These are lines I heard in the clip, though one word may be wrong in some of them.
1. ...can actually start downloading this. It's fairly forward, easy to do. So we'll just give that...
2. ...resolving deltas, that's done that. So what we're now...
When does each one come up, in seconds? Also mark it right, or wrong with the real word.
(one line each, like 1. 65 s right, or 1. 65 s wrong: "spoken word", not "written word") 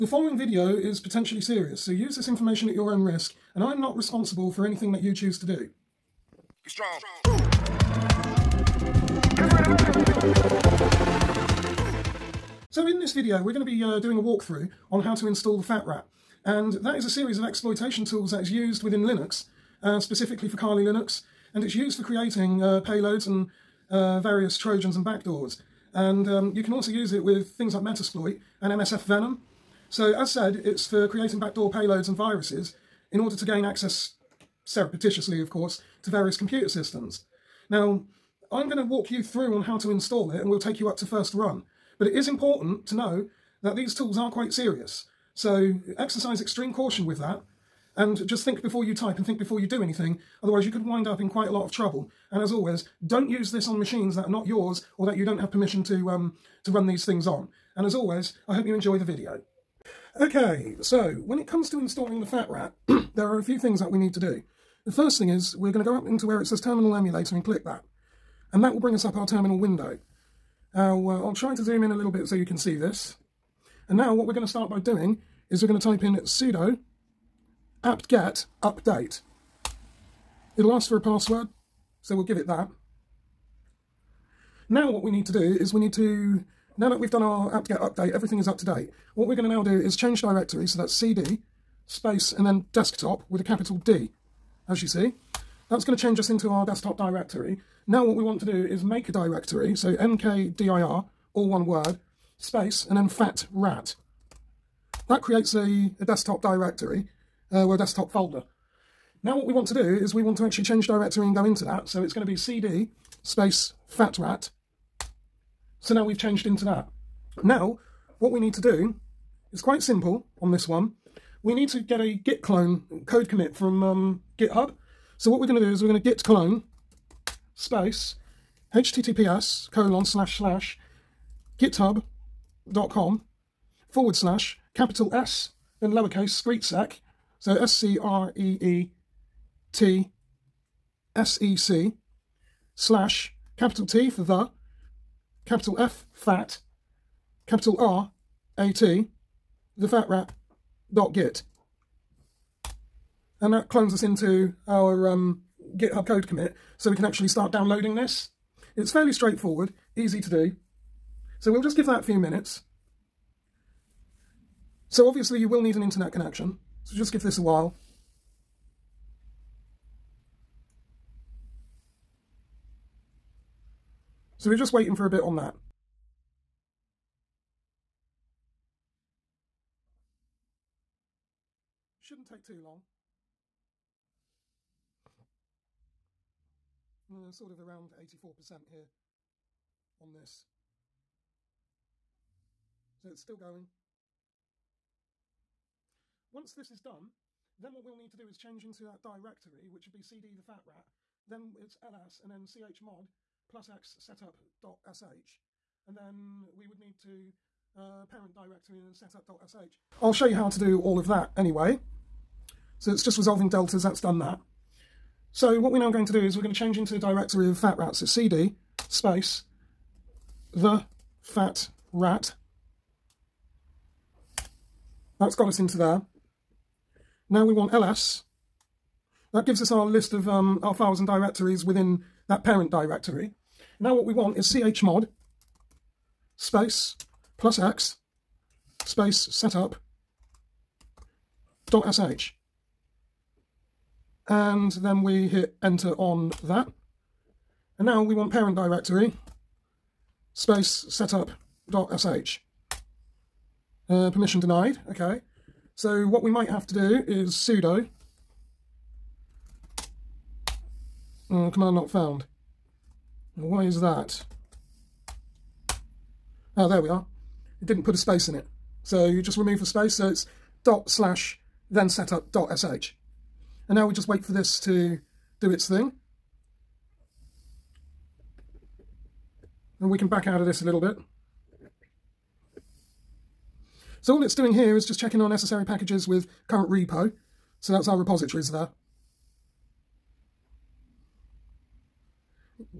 1. 156 s wrong: "straightforward", not "forward"
2. 213 s right.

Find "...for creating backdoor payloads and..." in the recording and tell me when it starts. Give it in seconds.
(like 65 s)
30 s.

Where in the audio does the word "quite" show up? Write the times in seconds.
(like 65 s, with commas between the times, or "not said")
44 s, 51 s, 119 s.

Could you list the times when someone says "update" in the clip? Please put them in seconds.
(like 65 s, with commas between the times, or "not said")
78 s, 87 s.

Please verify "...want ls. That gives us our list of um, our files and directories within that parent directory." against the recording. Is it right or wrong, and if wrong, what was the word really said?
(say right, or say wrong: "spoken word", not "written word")
right.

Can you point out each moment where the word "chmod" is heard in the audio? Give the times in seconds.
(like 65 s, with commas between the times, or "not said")
202 s, 234 s.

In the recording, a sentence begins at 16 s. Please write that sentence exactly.
And that is a series of exploitation tools that is used within Linux, uh, specifically for Kali Linux.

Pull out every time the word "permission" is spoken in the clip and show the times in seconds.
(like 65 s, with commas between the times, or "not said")
55 s, 254 s.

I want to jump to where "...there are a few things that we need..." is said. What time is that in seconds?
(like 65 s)
63 s.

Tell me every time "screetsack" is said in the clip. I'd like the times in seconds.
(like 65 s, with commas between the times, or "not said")
136 s.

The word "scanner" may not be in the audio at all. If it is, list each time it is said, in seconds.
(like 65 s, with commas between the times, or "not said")
not said.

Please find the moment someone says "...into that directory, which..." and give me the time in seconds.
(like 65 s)
198 s.